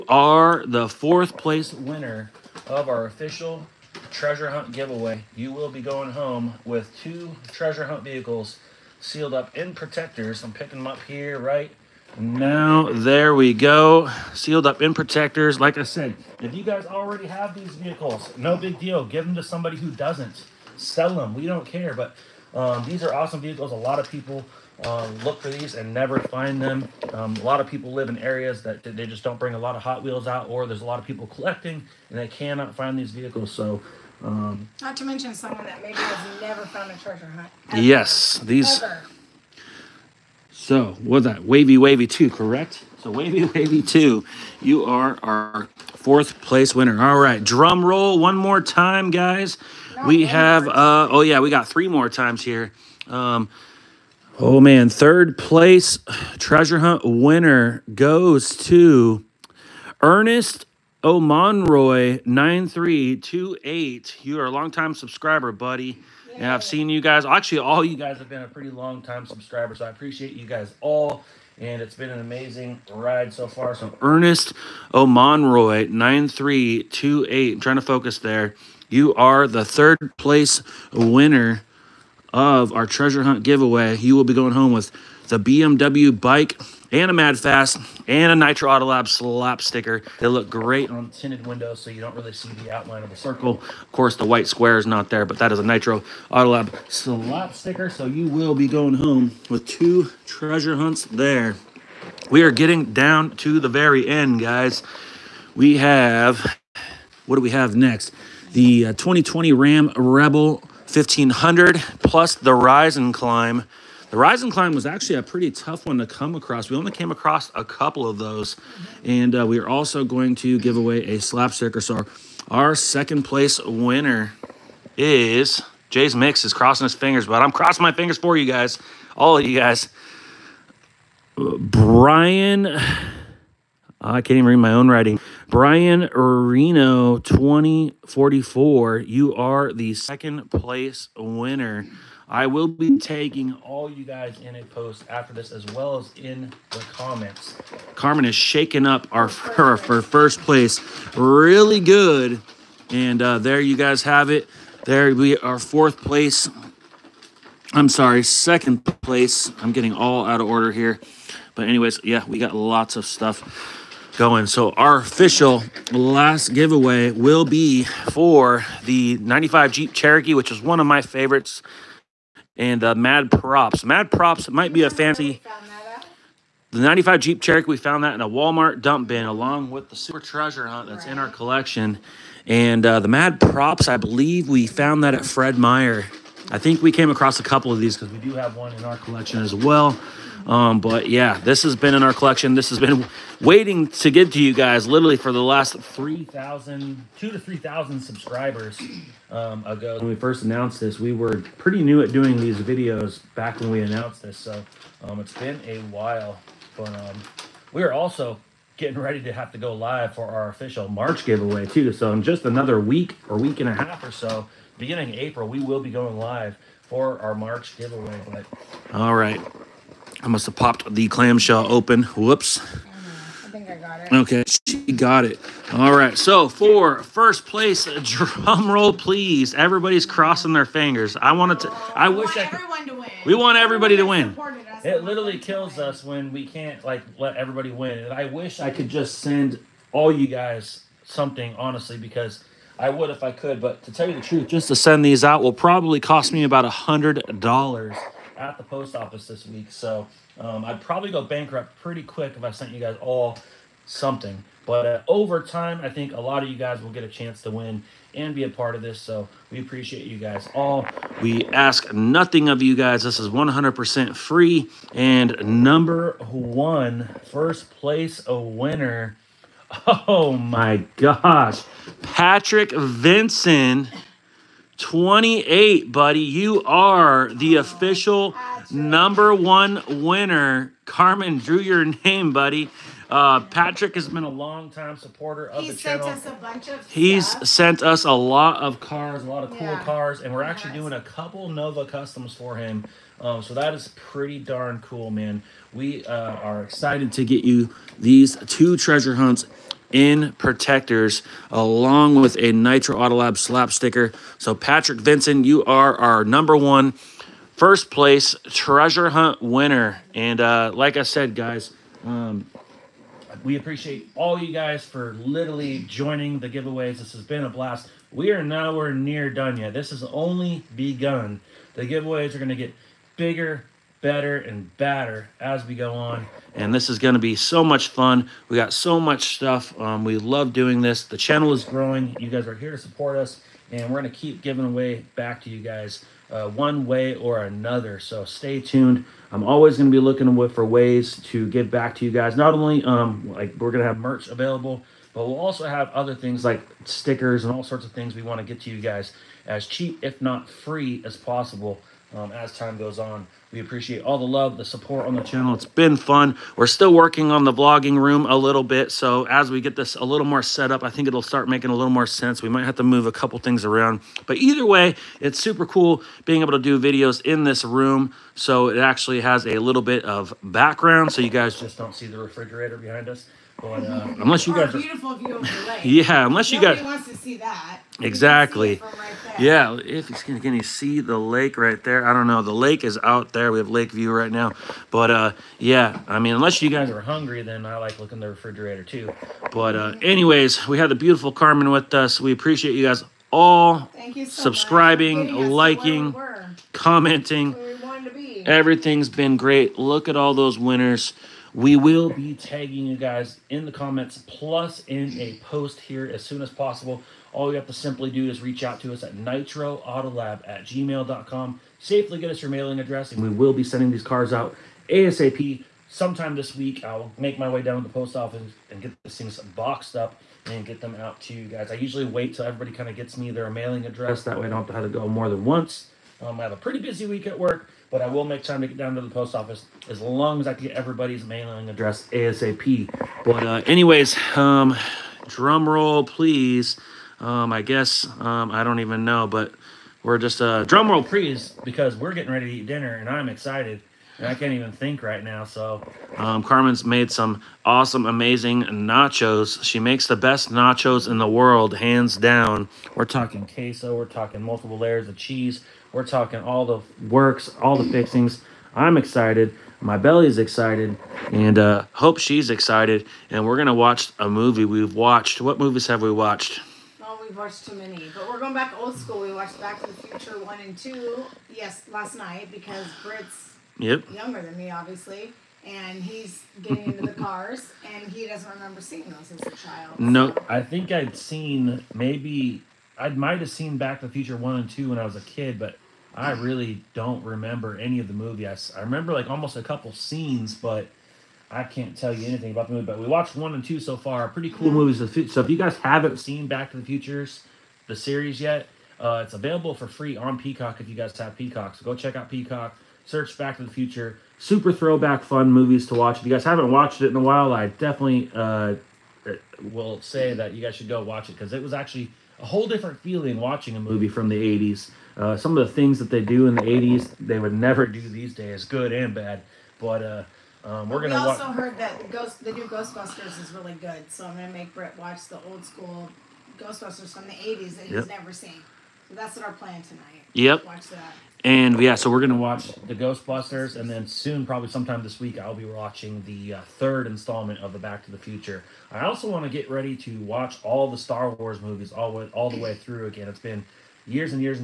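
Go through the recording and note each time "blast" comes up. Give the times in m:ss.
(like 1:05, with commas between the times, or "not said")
5:17.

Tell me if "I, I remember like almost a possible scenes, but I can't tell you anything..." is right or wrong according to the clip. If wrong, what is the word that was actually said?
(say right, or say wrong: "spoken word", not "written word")
wrong: "couple", not "possible".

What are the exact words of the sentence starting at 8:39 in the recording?
But uh, um, we're going to.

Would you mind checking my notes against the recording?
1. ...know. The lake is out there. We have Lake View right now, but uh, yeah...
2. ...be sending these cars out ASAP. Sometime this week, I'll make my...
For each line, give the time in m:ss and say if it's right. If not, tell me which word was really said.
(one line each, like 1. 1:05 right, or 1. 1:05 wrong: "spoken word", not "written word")
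1. 6:22 right
2. 6:53 right.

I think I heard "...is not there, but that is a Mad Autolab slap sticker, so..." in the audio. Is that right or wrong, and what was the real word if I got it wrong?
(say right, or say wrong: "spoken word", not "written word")
wrong: "Nitro", not "Mad".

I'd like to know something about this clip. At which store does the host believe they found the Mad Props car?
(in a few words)
Fred Meyer.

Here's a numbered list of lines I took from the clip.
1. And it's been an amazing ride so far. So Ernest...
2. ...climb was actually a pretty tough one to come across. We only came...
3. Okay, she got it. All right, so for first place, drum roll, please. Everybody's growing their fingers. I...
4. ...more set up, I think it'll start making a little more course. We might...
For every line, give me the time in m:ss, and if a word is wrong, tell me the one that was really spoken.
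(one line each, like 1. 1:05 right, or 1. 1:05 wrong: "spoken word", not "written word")
1. 1:11 right
2. 1:54 right
3. 3:44 wrong: "crossing", not "growing"
4. 6:00 wrong: "sense", not "course".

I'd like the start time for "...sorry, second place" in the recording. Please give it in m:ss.
2:37.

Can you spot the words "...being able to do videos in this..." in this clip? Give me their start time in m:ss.
6:06.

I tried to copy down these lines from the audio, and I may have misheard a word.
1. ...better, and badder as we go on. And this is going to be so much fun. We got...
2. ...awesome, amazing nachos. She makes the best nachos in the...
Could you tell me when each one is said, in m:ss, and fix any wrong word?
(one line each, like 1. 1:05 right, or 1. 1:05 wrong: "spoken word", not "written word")
1. 5:24 right
2. 7:27 right.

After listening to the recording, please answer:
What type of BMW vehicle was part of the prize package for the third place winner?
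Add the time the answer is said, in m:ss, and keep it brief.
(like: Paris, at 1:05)
bike, at 1:25.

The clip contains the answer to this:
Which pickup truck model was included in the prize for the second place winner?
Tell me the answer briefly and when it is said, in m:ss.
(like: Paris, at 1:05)
2020 Ram Rebel 1500, at 1:48.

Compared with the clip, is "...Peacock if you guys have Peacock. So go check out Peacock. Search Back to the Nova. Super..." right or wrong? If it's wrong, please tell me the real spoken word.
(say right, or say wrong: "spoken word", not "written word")
wrong: "Future", not "Nova".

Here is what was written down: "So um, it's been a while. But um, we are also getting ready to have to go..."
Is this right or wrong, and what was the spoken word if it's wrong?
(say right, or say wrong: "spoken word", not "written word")
right.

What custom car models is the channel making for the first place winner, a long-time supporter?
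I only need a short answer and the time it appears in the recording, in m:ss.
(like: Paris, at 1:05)
Nova customs, at 4:51.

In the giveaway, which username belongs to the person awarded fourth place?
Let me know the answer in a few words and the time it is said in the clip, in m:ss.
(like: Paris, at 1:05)
Wavy Wavy two, at 0:41.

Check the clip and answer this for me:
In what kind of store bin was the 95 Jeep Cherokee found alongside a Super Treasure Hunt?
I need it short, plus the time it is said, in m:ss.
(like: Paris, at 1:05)
Walmart dump bin, at 2:58.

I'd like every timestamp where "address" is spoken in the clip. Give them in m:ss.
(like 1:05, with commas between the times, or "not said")
6:52, 7:03, 7:11.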